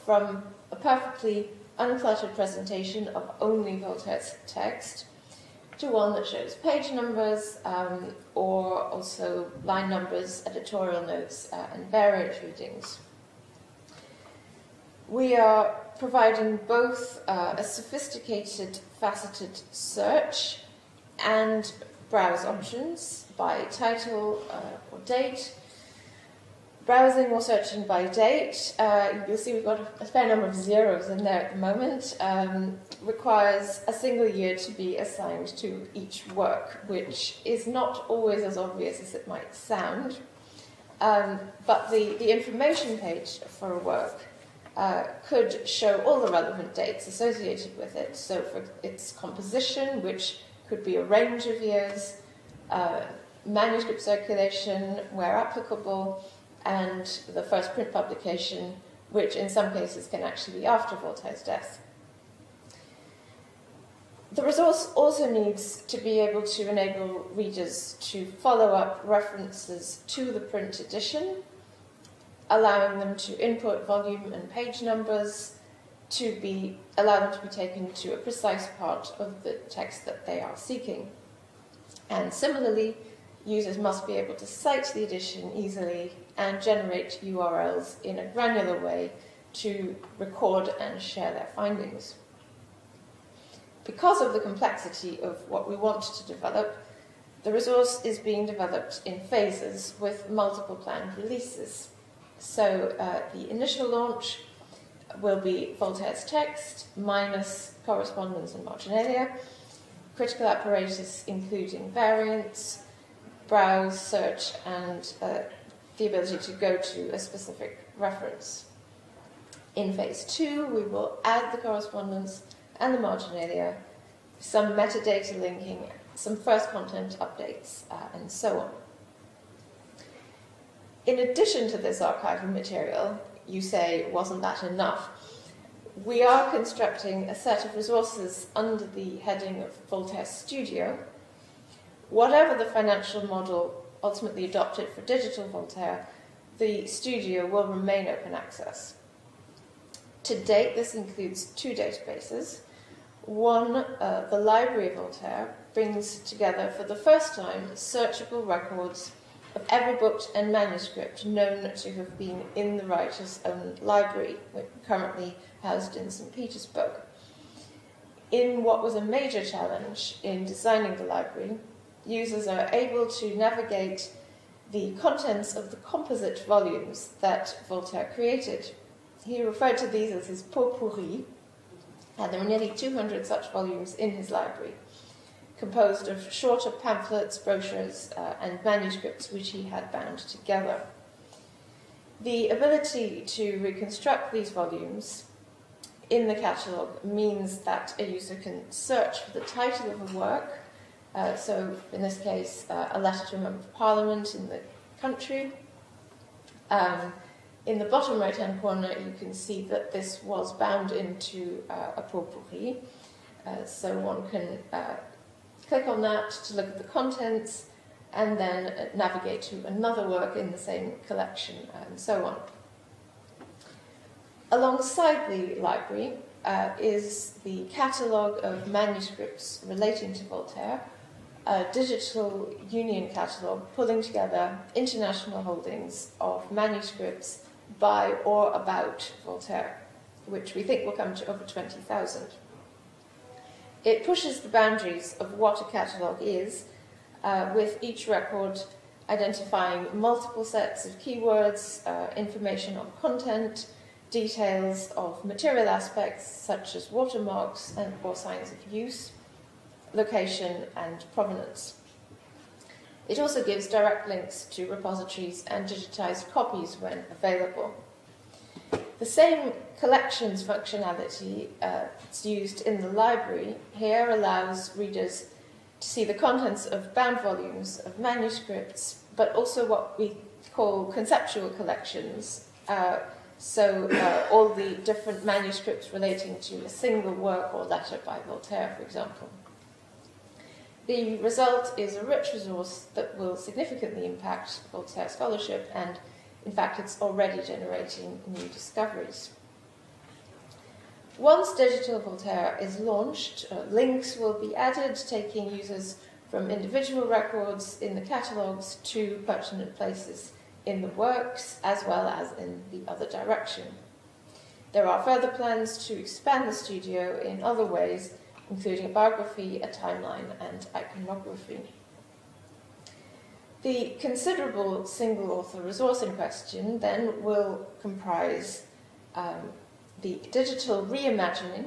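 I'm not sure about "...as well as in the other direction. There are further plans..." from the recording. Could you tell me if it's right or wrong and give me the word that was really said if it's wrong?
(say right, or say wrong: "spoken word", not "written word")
right.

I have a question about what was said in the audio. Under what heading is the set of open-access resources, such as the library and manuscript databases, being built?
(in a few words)
Voltaire Studio.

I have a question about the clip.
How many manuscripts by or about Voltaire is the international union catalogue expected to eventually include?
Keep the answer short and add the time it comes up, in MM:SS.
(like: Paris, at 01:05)
over 20,000, at 04:01.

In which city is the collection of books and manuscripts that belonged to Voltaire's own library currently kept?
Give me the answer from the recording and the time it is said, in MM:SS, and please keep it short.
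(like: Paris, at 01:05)
St. Petersburg, at 02:46.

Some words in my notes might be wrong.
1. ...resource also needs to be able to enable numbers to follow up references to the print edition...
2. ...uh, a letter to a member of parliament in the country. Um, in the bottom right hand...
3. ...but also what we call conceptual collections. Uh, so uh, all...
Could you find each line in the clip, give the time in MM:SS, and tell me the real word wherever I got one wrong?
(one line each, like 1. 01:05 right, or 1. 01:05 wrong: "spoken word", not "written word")
1. 01:04 wrong: "readers", not "numbers"
2. 03:22 right
3. 04:39 right.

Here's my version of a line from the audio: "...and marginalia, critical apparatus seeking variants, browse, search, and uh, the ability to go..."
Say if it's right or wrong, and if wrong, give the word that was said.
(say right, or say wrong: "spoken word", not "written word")
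wrong: "including", not "seeking".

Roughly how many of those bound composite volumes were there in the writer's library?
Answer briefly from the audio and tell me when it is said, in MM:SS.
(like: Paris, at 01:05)
nearly 200, at 03:02.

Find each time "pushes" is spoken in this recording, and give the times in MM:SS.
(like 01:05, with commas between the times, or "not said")
04:04.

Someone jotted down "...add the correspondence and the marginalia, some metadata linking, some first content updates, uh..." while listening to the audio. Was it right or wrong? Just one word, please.
right.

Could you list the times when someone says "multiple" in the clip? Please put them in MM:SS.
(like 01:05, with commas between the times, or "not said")
01:40, 04:09.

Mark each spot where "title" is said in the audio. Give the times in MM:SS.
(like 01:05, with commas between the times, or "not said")
00:23, 03:19.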